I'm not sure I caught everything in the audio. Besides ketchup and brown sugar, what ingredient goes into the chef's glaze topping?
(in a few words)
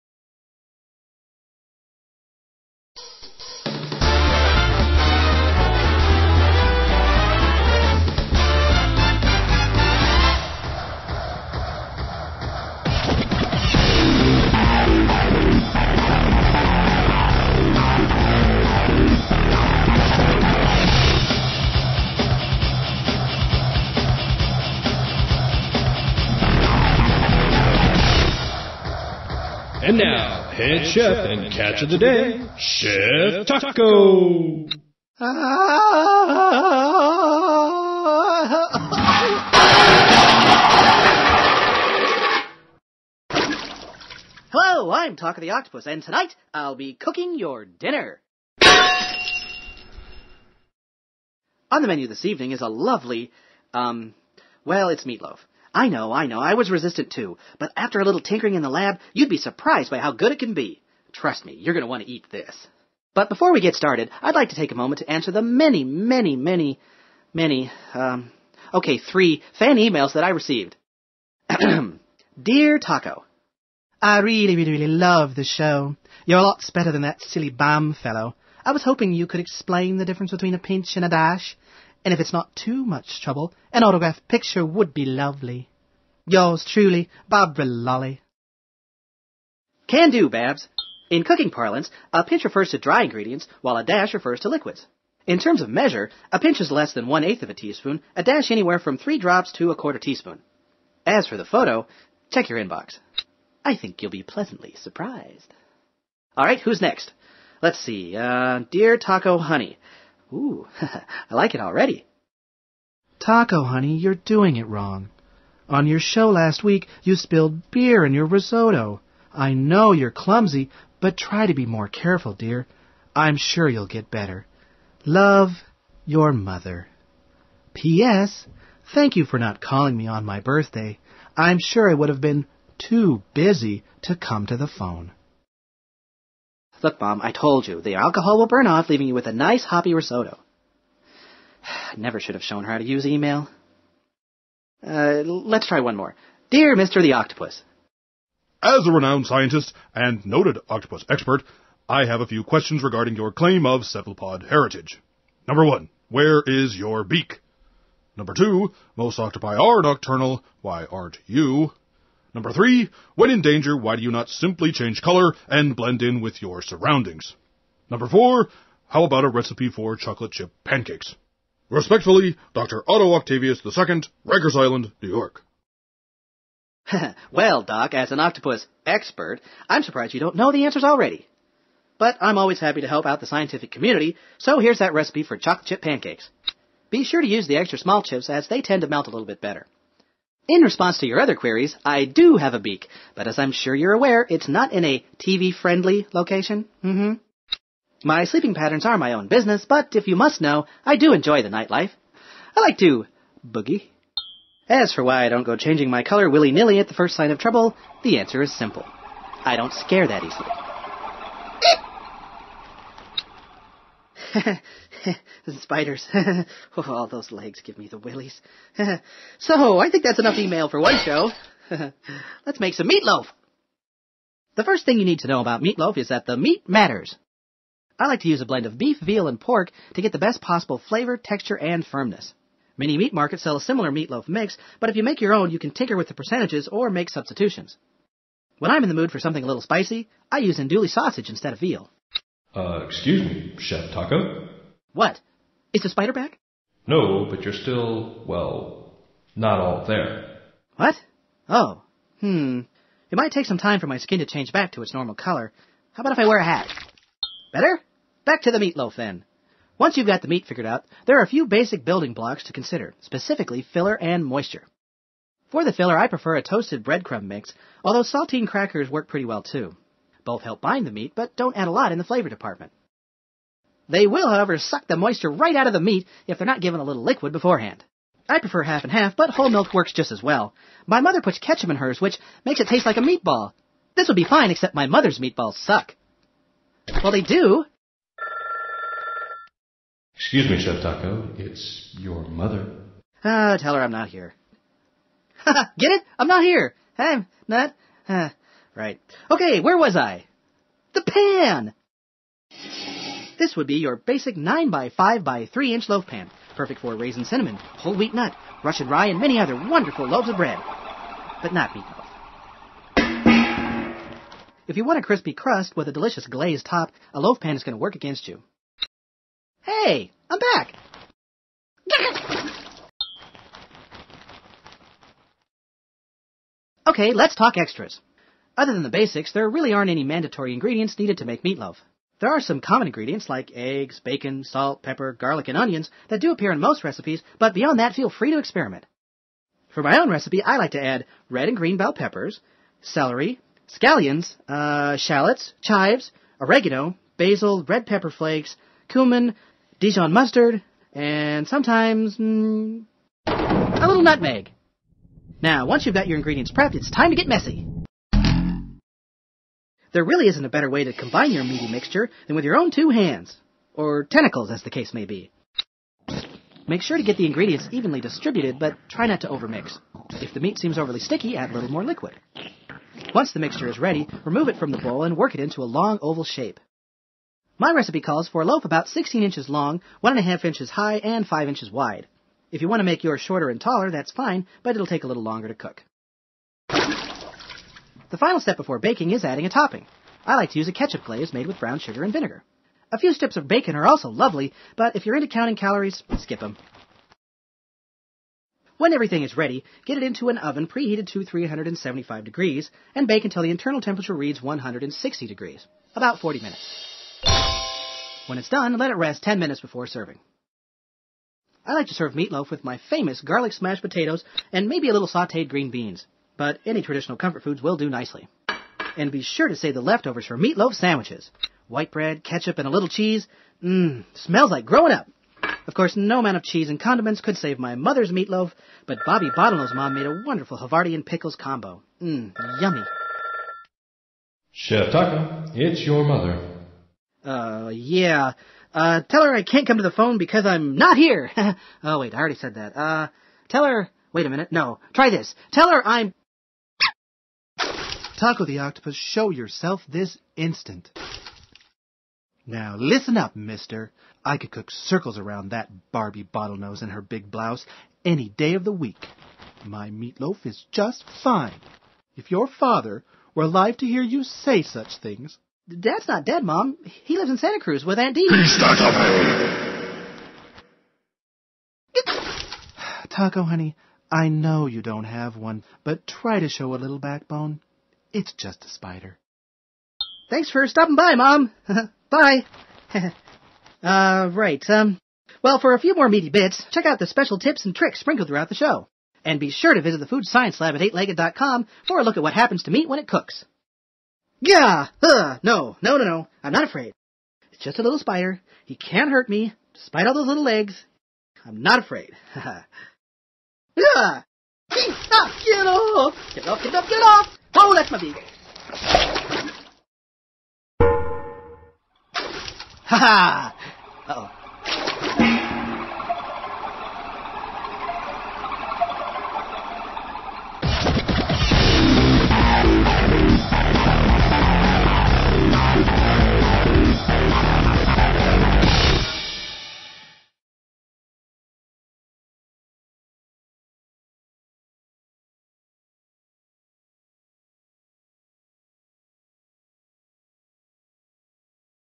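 vinegar.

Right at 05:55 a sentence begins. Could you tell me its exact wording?
Now, once you've got your ingredients prepped, it's time to get messy.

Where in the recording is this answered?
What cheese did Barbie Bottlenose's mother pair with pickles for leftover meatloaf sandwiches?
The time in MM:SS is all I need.
07:10.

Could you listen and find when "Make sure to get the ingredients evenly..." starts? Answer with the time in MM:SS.
06:06.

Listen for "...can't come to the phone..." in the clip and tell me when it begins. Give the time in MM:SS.
07:19.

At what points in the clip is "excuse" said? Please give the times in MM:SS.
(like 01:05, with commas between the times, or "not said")
04:02, 04:50.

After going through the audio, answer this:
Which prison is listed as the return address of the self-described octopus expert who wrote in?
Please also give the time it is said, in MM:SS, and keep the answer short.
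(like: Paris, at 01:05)
Rikers Island, at 02:54.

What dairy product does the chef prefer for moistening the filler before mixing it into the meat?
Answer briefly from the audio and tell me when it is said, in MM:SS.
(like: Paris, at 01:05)
half and half, at 04:38.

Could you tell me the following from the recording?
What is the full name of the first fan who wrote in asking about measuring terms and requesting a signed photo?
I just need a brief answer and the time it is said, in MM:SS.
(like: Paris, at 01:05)
Barbara Lolly, at 01:27.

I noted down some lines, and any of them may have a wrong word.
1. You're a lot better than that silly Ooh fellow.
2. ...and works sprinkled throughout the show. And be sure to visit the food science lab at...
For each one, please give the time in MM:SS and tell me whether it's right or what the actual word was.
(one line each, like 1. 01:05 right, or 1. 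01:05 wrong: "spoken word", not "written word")
1. 01:16 wrong: "BAM", not "Ooh"
2. 08:07 wrong: "tricks", not "works".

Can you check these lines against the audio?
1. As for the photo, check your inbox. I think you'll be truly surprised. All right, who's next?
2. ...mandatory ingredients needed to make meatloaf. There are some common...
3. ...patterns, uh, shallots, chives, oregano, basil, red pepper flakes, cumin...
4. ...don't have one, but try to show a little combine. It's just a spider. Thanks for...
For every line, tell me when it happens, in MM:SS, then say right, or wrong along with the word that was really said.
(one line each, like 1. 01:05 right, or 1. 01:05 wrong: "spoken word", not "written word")
1. 01:41 wrong: "pleasantly", not "truly"
2. 05:30 right
3. 05:43 wrong: "scallions", not "patterns"
4. 07:54 wrong: "backbone", not "combine".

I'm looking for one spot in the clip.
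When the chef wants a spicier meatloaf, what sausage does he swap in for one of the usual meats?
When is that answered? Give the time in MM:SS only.
04:00.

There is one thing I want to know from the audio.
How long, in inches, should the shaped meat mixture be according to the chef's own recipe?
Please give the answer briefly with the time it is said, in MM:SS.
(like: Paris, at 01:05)
16 inches, at 06:18.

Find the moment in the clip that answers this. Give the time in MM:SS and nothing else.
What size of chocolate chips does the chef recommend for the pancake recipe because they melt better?
03:07.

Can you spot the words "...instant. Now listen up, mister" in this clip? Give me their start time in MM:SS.
07:30.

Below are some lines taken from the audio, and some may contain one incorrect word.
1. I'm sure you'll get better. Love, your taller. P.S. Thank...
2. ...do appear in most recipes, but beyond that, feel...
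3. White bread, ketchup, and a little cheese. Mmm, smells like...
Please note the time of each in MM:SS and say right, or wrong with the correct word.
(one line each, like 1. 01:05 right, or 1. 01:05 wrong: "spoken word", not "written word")
1. 02:03 wrong: "mother", not "taller"
2. 05:36 right
3. 07:01 right.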